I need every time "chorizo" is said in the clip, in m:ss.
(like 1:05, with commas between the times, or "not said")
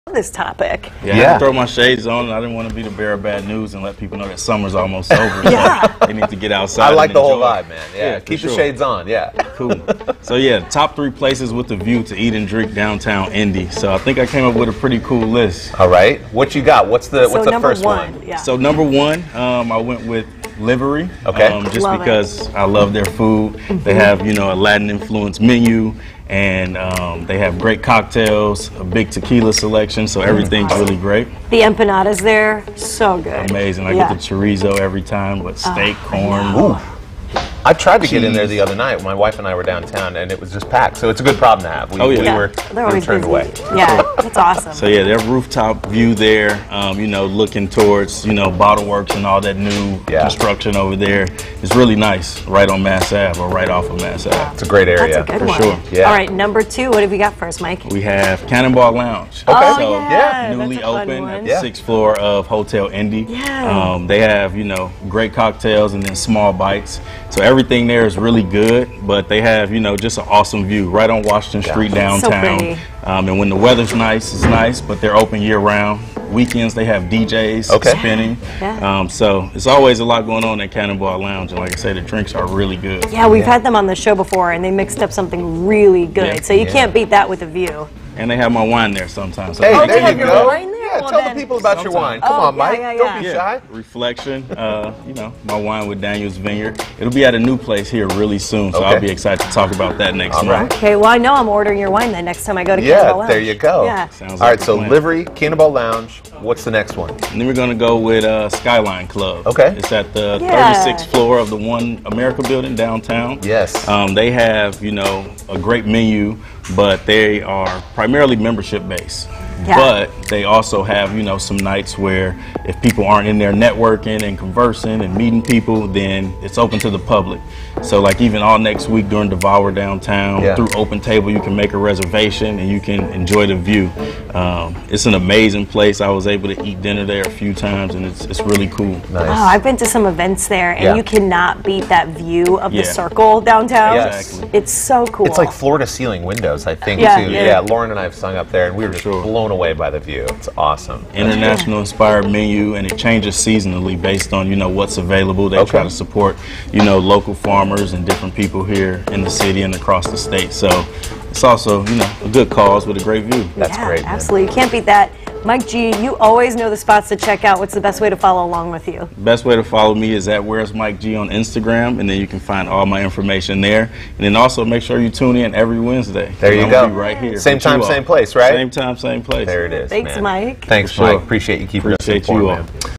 0:34.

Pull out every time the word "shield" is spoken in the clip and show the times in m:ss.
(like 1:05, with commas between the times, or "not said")
not said.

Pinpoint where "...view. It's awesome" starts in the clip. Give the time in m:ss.
2:29.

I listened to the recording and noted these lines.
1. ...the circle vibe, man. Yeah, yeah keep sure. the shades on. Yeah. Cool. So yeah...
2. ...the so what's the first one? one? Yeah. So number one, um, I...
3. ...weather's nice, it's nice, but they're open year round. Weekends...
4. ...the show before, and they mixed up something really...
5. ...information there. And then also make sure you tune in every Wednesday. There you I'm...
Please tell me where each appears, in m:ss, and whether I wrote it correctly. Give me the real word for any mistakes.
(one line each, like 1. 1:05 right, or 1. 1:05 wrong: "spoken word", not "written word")
1. 0:07 wrong: "whole", not "circle"
2. 0:17 right
3. 1:13 right
4. 1:23 right
5. 2:53 right.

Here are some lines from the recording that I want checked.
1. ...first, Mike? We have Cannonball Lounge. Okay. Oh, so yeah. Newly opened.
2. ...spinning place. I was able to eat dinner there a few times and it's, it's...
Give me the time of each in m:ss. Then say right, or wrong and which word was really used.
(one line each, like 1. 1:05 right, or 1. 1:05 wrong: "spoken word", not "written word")
1. 0:57 right
2. 2:15 wrong: "amazing", not "spinning".